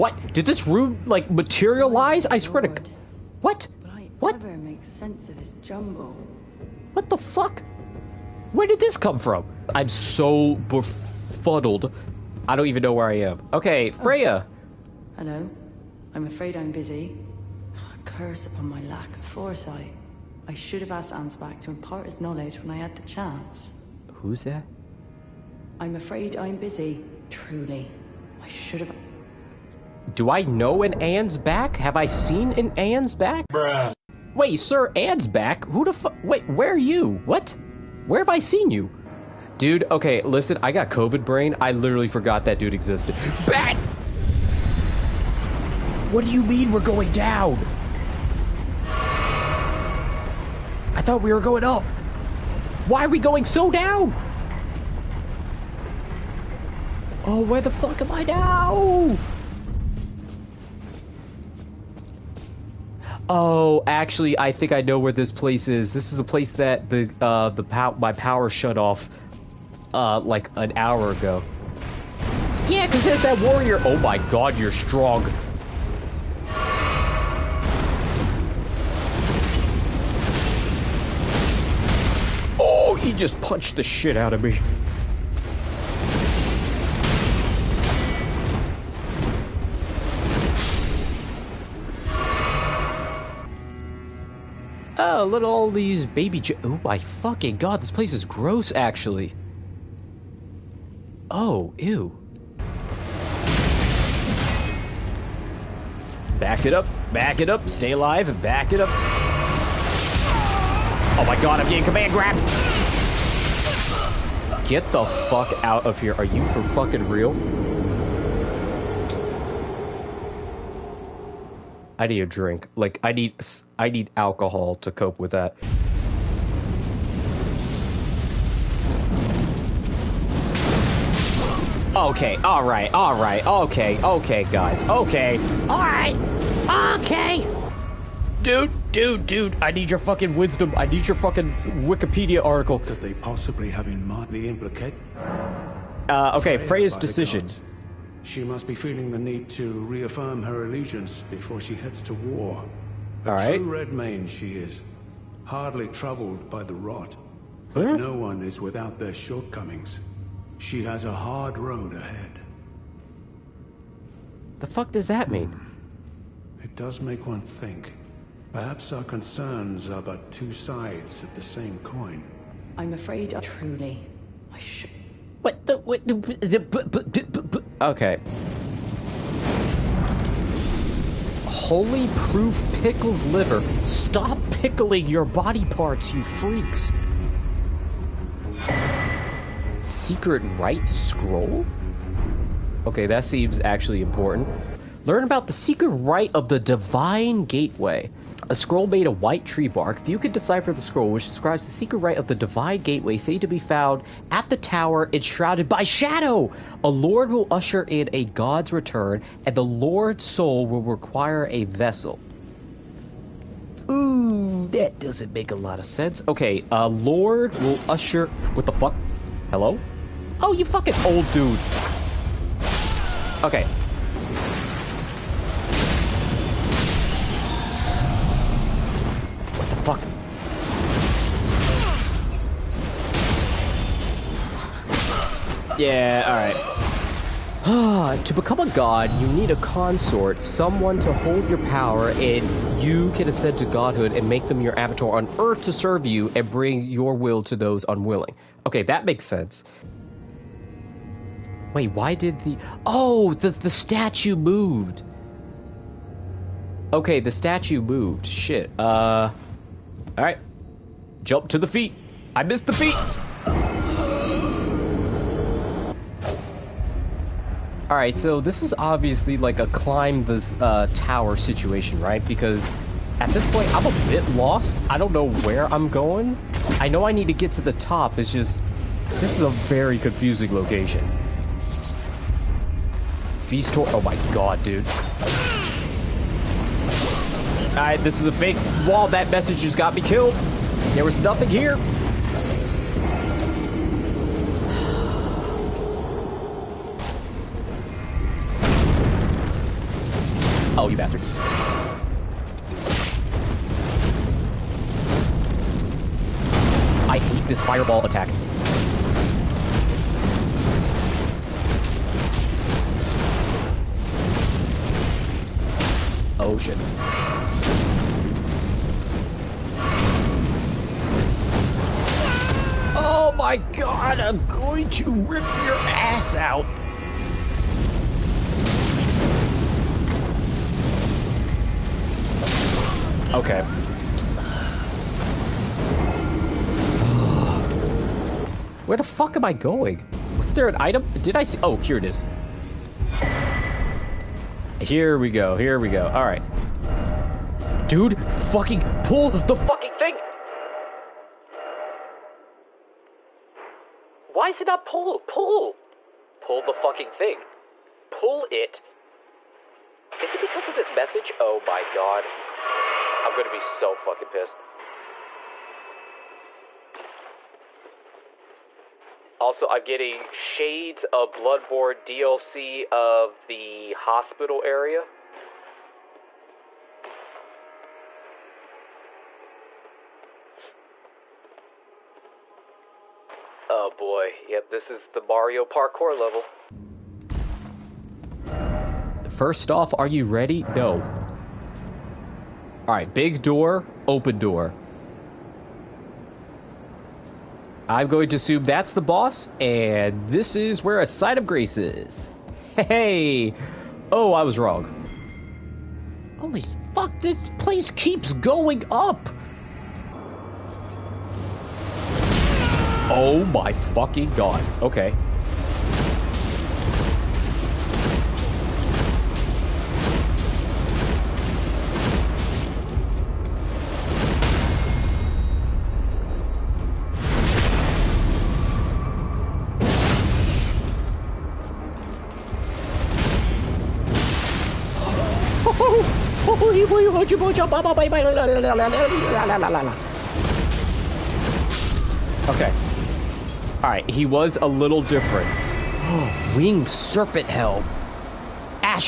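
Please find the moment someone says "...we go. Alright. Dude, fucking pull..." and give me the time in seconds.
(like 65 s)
345 s.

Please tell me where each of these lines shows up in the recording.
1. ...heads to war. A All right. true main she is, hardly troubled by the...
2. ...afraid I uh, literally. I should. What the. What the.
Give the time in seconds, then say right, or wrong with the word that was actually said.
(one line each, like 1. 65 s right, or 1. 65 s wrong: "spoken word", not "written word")
1. 151 s right
2. 172 s wrong: "truly", not "literally".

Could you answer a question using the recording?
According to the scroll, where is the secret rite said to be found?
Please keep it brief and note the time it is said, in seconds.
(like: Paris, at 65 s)
the tower enshrouded by shadow, at 204 s.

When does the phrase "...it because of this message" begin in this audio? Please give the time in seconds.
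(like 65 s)
360 s.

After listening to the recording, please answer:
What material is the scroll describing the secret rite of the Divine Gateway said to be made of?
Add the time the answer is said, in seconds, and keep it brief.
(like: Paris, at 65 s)
white tree bark, at 199 s.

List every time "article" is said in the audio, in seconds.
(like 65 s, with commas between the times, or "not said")
142 s.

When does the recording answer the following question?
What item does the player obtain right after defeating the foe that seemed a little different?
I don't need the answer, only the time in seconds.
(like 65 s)
446 s.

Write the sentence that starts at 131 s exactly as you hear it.
Okay, alright, alright, okay, okay, guys, okay.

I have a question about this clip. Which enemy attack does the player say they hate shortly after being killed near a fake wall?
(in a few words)
fireball attack.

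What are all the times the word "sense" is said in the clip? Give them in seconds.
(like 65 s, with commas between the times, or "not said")
4 s, 215 s, 249 s.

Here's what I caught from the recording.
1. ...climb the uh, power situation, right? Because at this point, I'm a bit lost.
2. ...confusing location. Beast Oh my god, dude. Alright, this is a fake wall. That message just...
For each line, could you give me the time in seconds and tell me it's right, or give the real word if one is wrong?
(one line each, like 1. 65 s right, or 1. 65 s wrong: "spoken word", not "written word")
1. 269 s wrong: "tower", not "power"
2. 279 s right.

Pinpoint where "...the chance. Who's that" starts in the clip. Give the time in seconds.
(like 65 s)
22 s.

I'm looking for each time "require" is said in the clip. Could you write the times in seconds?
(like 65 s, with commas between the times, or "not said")
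210 s.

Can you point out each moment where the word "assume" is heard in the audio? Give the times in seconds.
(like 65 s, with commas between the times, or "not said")
398 s.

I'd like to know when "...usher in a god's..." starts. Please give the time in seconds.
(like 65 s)
207 s.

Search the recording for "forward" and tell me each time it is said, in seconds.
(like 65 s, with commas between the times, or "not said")
not said.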